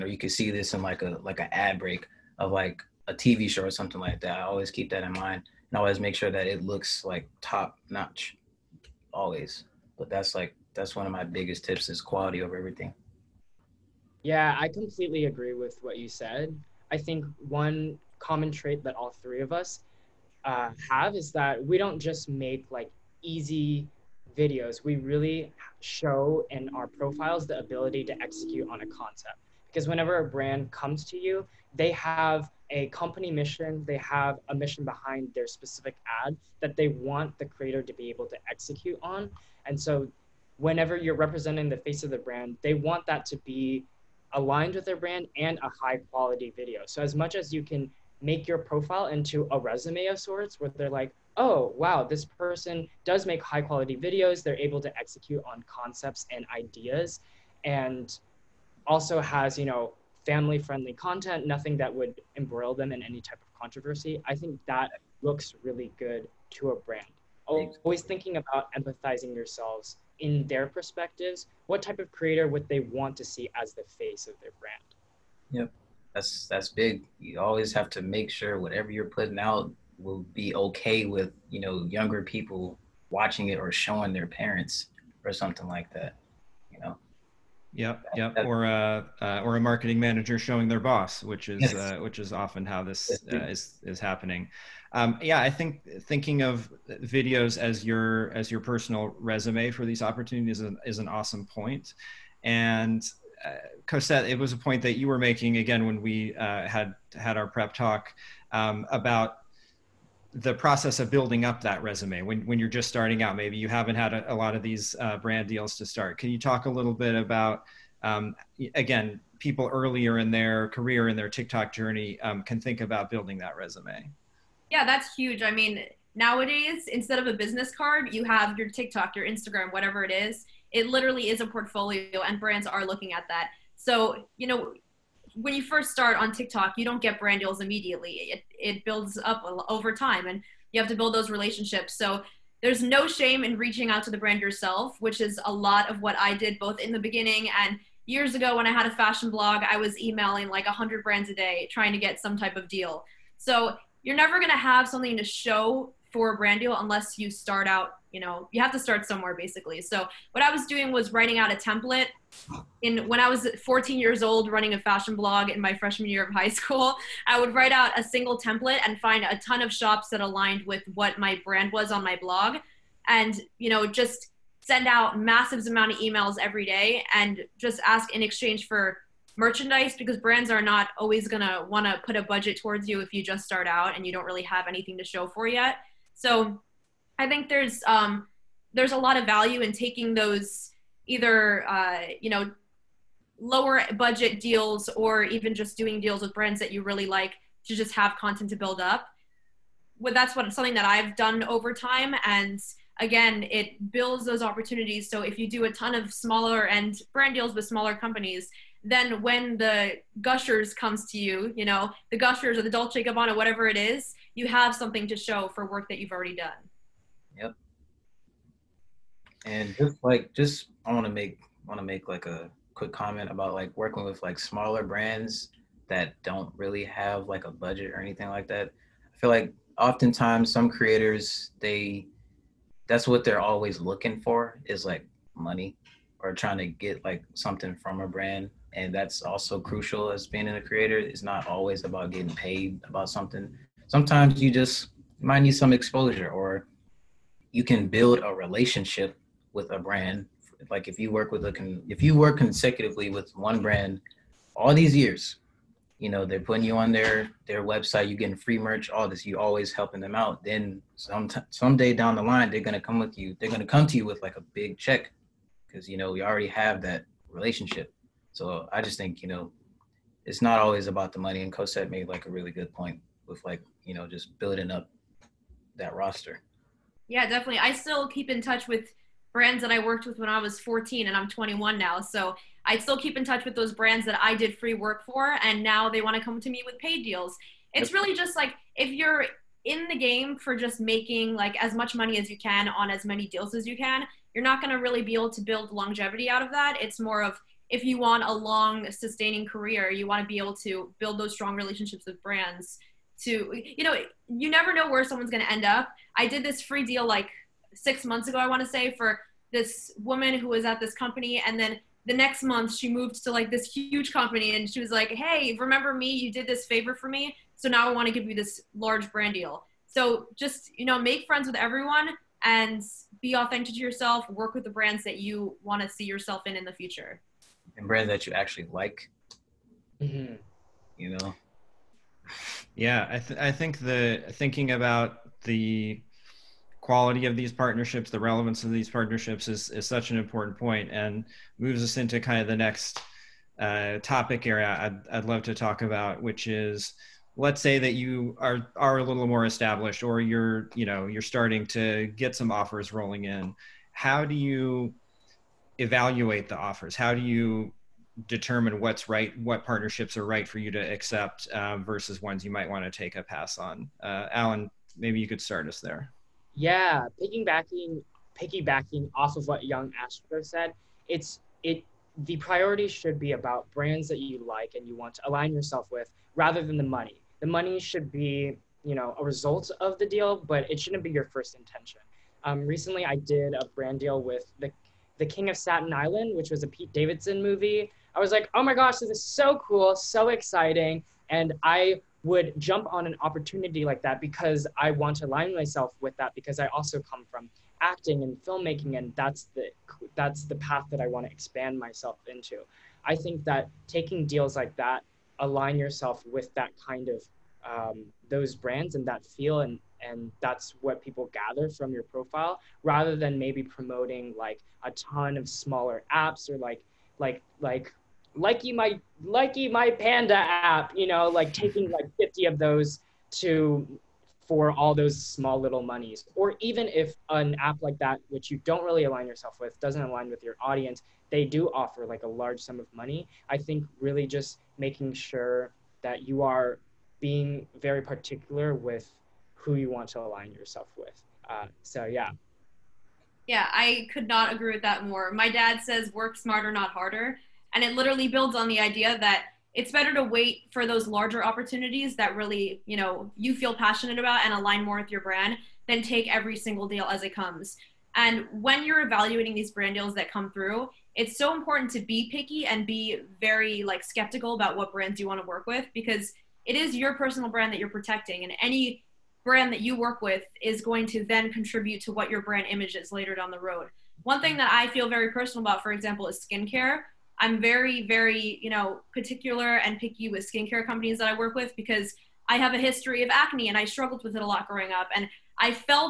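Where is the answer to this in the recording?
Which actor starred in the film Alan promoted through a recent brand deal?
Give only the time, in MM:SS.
06:26.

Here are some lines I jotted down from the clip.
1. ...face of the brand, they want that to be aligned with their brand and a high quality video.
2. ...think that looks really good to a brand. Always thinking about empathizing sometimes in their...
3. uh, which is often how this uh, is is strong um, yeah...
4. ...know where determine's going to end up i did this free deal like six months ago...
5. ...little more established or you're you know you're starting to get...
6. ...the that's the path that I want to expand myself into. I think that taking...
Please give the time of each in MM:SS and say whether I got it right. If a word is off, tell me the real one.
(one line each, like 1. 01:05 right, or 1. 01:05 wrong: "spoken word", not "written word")
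1. 00:41 right
2. 01:04 wrong: "yourselves", not "sometimes"
3. 01:31 wrong: "happening", not "strong"
4. 05:04 wrong: "someone", not "determine"
5. 05:49 right
6. 06:39 right.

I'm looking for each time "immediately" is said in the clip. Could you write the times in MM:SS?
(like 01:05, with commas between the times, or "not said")
02:17.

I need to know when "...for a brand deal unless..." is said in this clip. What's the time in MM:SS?
02:36.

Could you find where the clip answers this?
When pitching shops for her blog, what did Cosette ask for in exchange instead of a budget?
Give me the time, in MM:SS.
02:59.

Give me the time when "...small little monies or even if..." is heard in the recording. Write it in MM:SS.
07:05.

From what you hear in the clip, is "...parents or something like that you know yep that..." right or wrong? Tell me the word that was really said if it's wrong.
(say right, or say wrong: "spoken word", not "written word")
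right.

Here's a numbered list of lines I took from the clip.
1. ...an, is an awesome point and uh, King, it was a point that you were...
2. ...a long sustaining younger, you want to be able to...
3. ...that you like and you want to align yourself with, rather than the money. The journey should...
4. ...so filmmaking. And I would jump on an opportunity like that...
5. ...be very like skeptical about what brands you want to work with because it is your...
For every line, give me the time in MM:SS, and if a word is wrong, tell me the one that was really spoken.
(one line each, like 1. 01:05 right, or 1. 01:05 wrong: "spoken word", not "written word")
1. 01:40 wrong: "Cosette", not "King"
2. 04:58 wrong: "career", not "younger"
3. 06:14 wrong: "money", not "journey"
4. 06:29 wrong: "exciting", not "filmmaking"
5. 07:42 right.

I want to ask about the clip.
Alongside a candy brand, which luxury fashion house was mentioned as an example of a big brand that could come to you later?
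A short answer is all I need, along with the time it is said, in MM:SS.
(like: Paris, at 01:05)
Dolce & Gabbana, at 03:32.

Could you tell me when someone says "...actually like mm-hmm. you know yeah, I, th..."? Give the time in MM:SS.
05:28.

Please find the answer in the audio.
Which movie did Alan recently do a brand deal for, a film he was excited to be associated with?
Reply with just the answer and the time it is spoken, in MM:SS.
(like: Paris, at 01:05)
The King of Staten Island, at 06:25.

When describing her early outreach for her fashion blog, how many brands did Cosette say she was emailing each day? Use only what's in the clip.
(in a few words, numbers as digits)
100.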